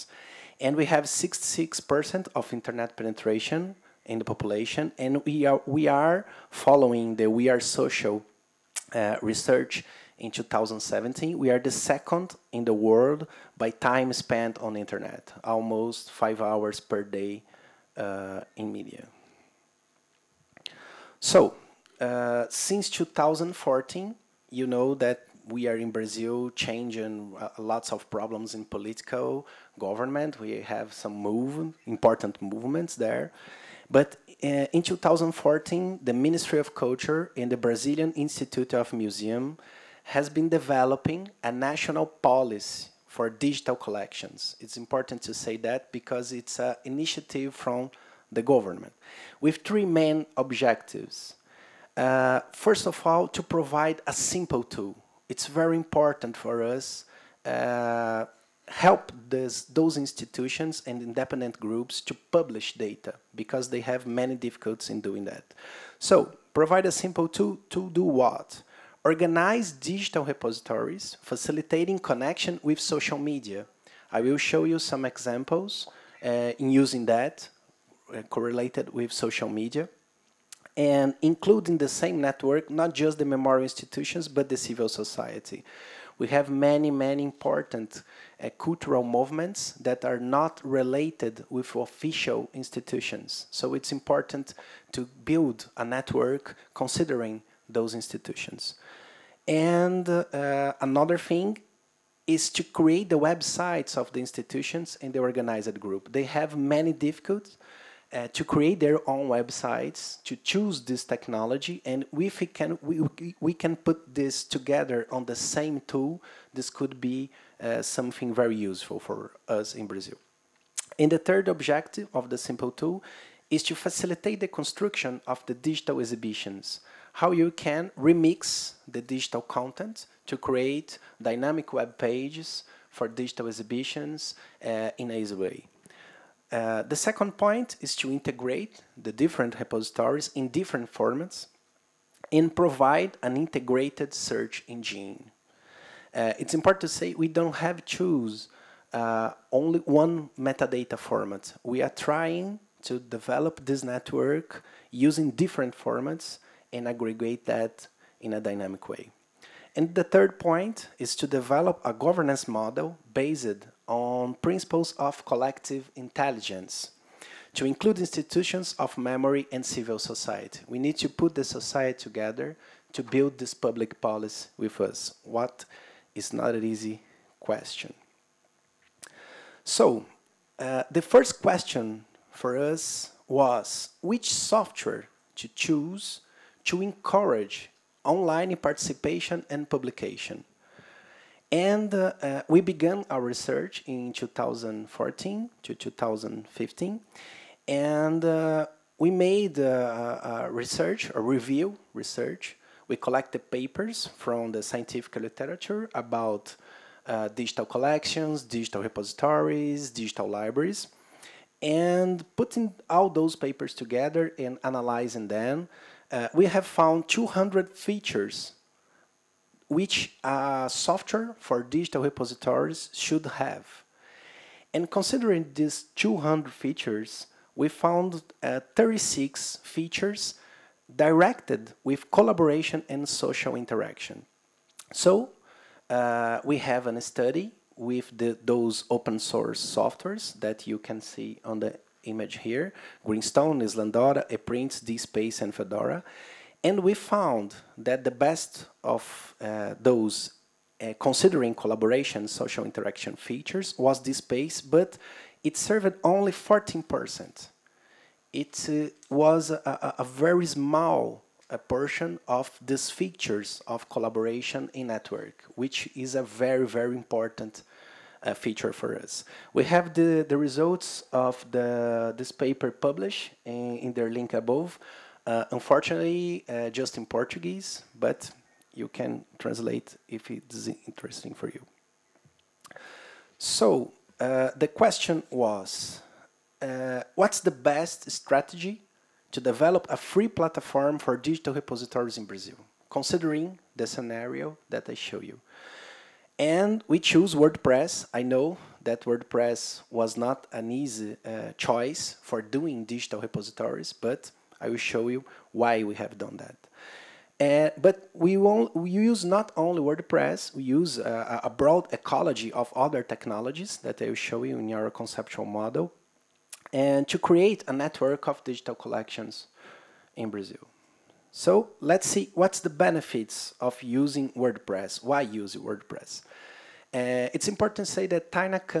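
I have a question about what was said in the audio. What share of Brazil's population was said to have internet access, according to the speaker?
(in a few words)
66%.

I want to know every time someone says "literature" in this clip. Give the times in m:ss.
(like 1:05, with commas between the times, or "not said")
3:25.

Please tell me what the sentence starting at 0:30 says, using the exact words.
We have some move, important movements there.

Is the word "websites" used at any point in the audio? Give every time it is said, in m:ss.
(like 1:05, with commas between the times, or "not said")
1:43, 1:49.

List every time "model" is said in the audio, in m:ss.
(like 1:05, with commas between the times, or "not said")
2:42, 5:15.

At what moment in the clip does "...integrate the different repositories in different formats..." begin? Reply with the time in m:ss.
2:18.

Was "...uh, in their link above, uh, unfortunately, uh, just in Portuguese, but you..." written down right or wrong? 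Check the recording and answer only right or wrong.
right.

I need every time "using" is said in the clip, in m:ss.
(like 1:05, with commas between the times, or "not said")
1:16, 2:34, 5:23.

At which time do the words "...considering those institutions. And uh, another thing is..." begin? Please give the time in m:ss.
1:36.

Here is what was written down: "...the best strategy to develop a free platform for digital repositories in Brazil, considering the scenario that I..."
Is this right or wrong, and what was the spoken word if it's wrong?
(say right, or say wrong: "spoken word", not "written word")
right.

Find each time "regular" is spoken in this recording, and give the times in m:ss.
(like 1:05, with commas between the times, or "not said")
not said.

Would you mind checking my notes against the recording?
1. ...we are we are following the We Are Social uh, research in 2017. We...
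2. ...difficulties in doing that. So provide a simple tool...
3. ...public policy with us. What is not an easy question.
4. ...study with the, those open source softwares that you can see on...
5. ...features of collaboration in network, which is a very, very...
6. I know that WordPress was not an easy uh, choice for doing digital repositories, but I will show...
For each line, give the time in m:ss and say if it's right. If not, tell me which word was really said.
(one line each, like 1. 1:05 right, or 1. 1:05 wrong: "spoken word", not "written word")
1. 0:05 right
2. 1:04 right
3. 2:53 right
4. 3:56 right
5. 4:22 right
6. 4:58 right.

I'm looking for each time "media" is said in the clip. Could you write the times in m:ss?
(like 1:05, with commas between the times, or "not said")
0:18, 1:13, 1:19.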